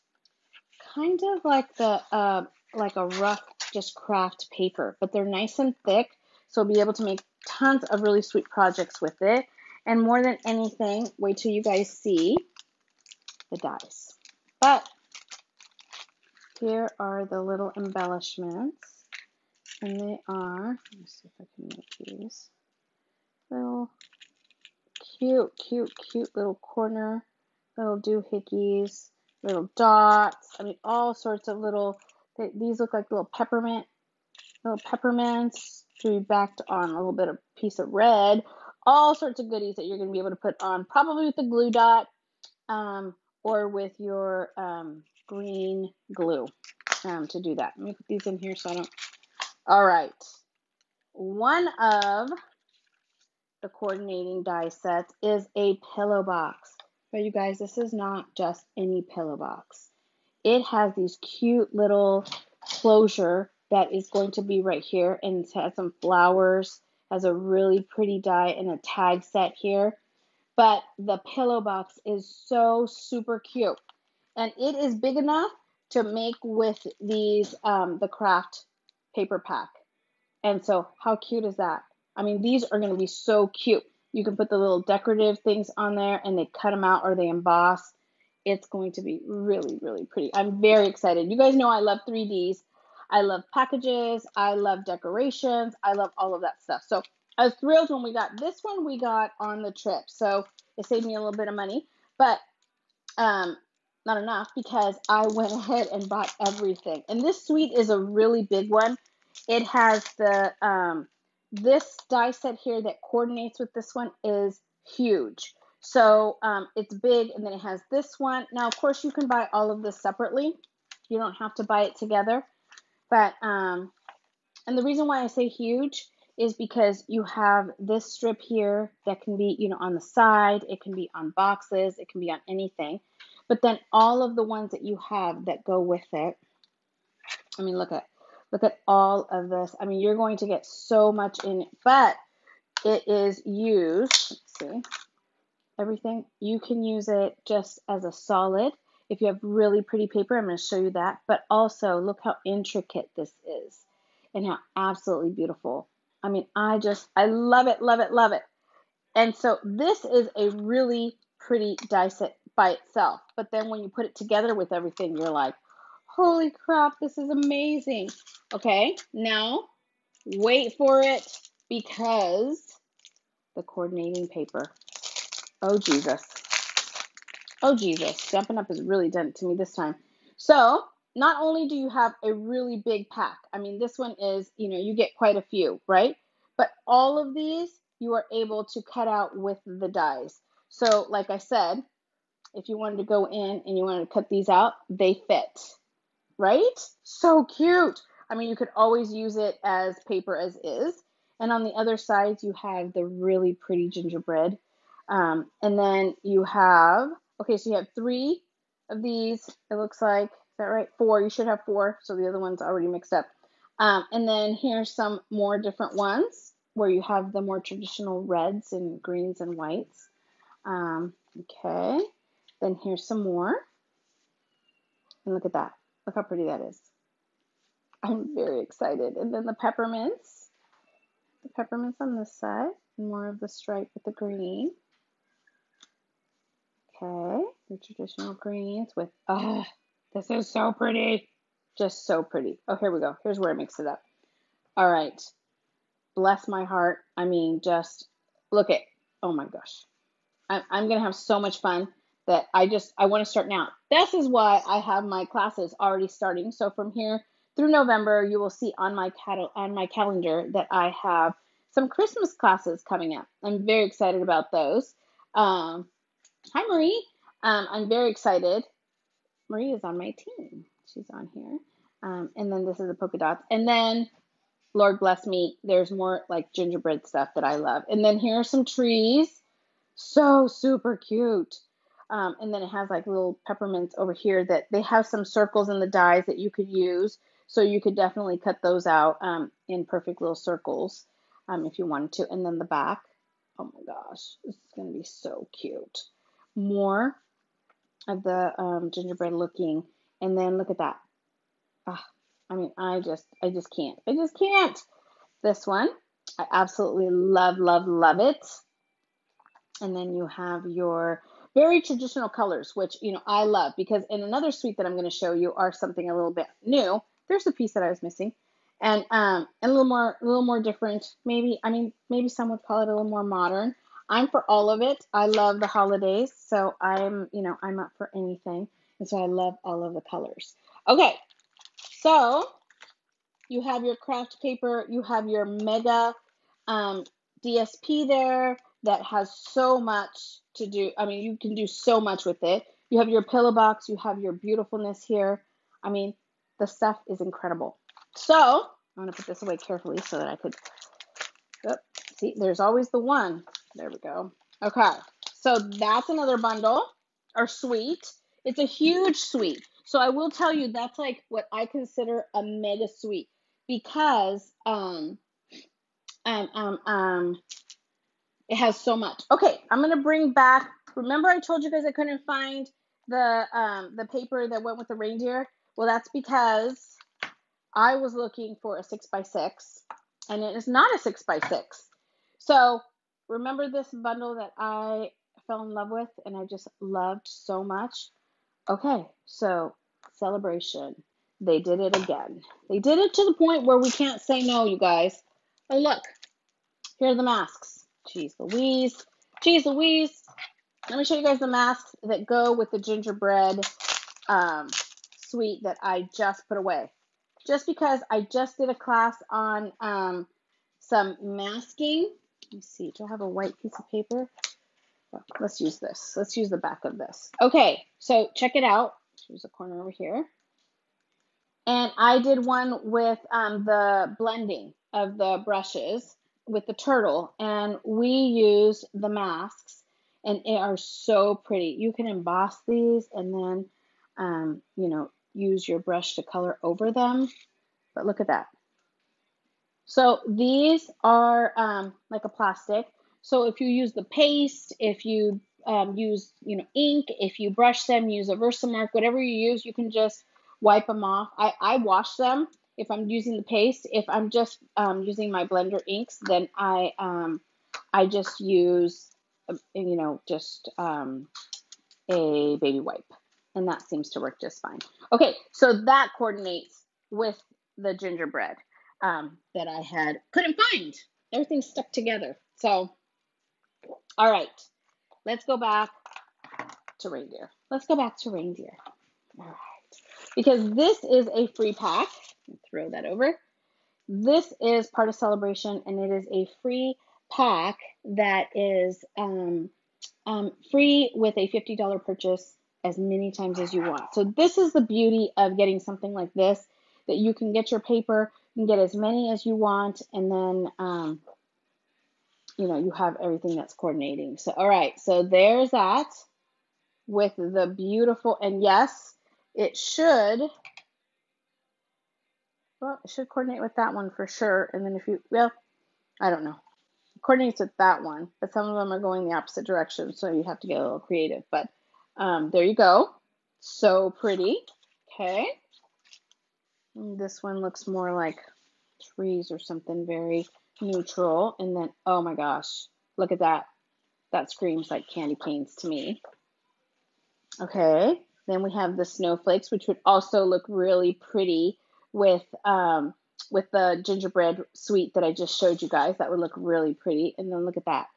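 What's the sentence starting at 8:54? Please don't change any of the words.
That screams like candy canes to me.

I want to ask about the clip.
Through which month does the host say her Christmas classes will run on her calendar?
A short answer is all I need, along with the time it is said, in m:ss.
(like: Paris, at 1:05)
November, at 4:17.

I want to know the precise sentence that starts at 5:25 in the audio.
I love the holidays, so I'm you know I'm up for anything, and so I love all of the colors.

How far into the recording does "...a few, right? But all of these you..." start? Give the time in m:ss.
3:05.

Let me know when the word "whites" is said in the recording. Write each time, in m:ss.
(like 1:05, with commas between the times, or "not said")
3:39, 6:53.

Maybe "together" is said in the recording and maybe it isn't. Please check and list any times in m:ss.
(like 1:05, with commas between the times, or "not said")
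2:01, 2:44, 7:51.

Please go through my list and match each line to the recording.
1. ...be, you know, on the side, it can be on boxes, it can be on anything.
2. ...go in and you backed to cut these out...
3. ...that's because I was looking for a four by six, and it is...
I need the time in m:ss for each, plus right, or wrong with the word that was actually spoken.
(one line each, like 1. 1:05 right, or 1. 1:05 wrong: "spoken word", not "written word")
1. 2:09 right
2. 3:13 wrong: "wanted", not "backed"
3. 6:15 wrong: "six", not "four".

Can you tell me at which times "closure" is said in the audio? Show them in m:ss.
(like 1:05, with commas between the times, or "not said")
1:02.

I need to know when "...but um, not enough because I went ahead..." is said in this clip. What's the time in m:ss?
1:42.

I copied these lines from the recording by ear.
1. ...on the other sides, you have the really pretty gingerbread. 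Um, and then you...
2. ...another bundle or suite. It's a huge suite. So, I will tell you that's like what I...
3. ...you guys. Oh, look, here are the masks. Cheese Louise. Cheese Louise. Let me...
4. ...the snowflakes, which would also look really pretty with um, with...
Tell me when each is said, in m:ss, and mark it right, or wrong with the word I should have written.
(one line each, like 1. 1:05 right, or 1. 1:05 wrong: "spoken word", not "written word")
1. 3:21 right
2. 5:56 right
3. 6:34 right
4. 8:58 right.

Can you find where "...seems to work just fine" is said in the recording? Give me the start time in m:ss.
7:43.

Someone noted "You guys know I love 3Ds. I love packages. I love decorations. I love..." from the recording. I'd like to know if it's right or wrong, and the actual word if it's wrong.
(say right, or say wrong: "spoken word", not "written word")
right.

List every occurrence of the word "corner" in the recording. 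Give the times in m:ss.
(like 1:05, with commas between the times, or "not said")
0:26, 6:59.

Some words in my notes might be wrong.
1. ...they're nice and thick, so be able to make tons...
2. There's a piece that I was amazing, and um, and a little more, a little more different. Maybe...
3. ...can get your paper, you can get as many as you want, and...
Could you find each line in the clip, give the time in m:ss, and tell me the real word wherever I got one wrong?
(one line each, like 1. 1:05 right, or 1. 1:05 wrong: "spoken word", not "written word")
1. 0:05 right
2. 5:17 wrong: "missing", not "amazing"
3. 8:17 right.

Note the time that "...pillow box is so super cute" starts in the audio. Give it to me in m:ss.
1:11.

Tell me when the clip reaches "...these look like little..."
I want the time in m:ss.
0:32.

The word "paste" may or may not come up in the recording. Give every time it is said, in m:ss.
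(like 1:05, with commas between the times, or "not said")
7:24, 7:33.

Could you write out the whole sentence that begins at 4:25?
Um, hi Marie, um, I'm very excited.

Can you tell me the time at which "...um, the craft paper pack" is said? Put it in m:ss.
1:17.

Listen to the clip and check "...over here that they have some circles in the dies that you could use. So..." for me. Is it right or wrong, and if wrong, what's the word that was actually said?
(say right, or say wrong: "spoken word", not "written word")
right.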